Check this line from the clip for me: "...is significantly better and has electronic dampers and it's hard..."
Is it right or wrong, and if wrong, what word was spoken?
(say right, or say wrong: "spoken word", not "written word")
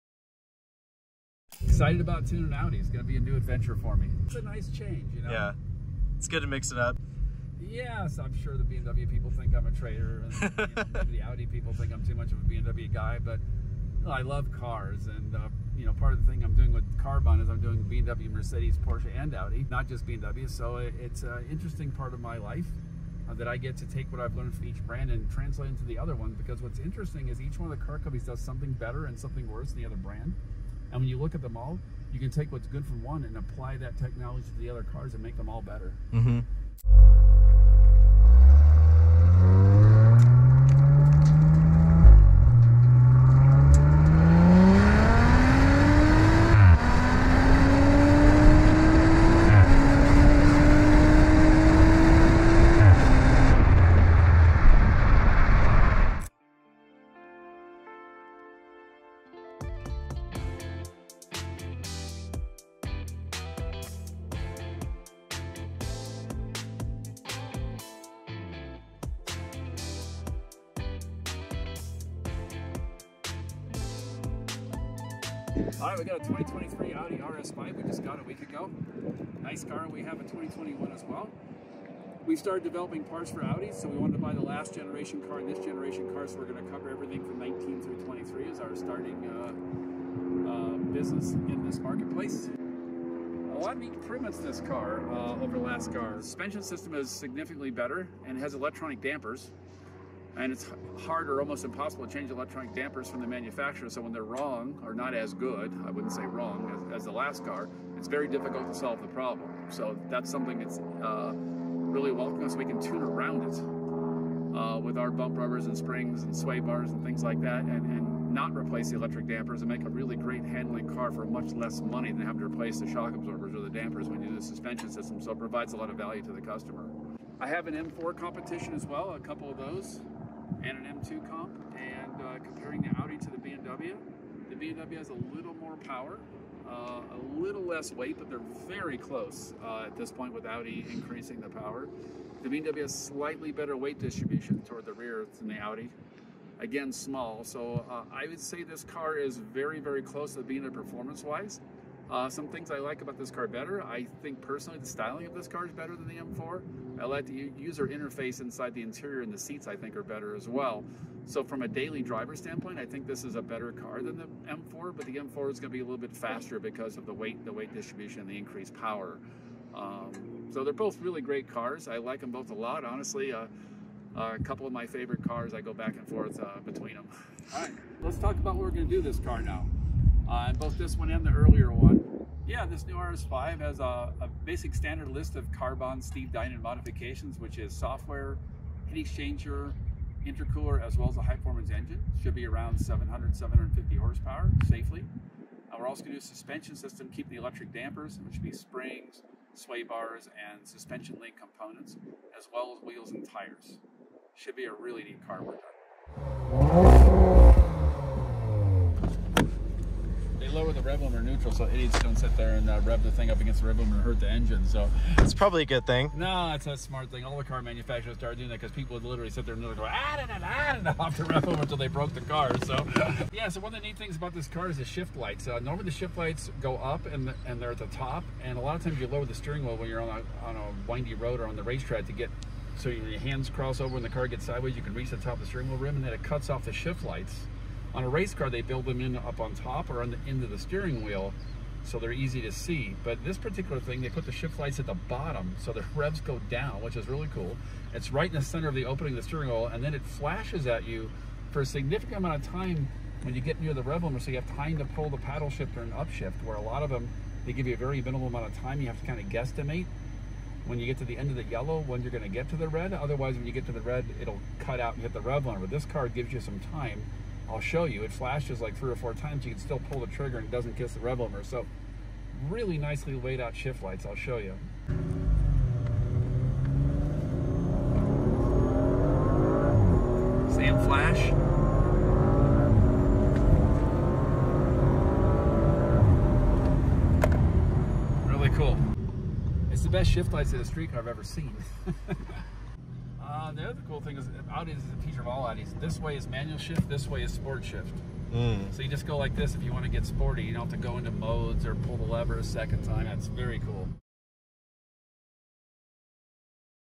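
right.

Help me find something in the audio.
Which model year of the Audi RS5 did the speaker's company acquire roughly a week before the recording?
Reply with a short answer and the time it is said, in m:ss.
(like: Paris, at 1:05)
2023, at 1:16.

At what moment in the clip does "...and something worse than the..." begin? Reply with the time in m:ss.
0:29.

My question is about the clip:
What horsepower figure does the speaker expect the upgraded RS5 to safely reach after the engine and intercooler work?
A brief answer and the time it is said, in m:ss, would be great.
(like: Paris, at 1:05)
700-750, at 3:12.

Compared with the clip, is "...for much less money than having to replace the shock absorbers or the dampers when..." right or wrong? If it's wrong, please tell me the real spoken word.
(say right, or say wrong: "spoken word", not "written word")
right.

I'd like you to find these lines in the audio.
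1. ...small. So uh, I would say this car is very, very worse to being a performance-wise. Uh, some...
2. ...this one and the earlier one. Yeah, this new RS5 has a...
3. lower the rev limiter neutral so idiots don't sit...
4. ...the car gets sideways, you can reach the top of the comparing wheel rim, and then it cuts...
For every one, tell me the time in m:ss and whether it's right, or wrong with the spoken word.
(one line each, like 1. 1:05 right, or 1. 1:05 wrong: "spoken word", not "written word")
1. 2:26 wrong: "close", not "worse"
2. 3:00 right
3. 3:30 right
4. 3:54 wrong: "steering", not "comparing".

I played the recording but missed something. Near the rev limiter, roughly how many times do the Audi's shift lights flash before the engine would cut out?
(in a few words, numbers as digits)
3 or 4.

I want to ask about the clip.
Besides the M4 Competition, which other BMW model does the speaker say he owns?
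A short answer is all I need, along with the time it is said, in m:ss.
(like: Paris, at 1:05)
M2 comp, at 2:10.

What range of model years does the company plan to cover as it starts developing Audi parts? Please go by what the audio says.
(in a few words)
19 through 23.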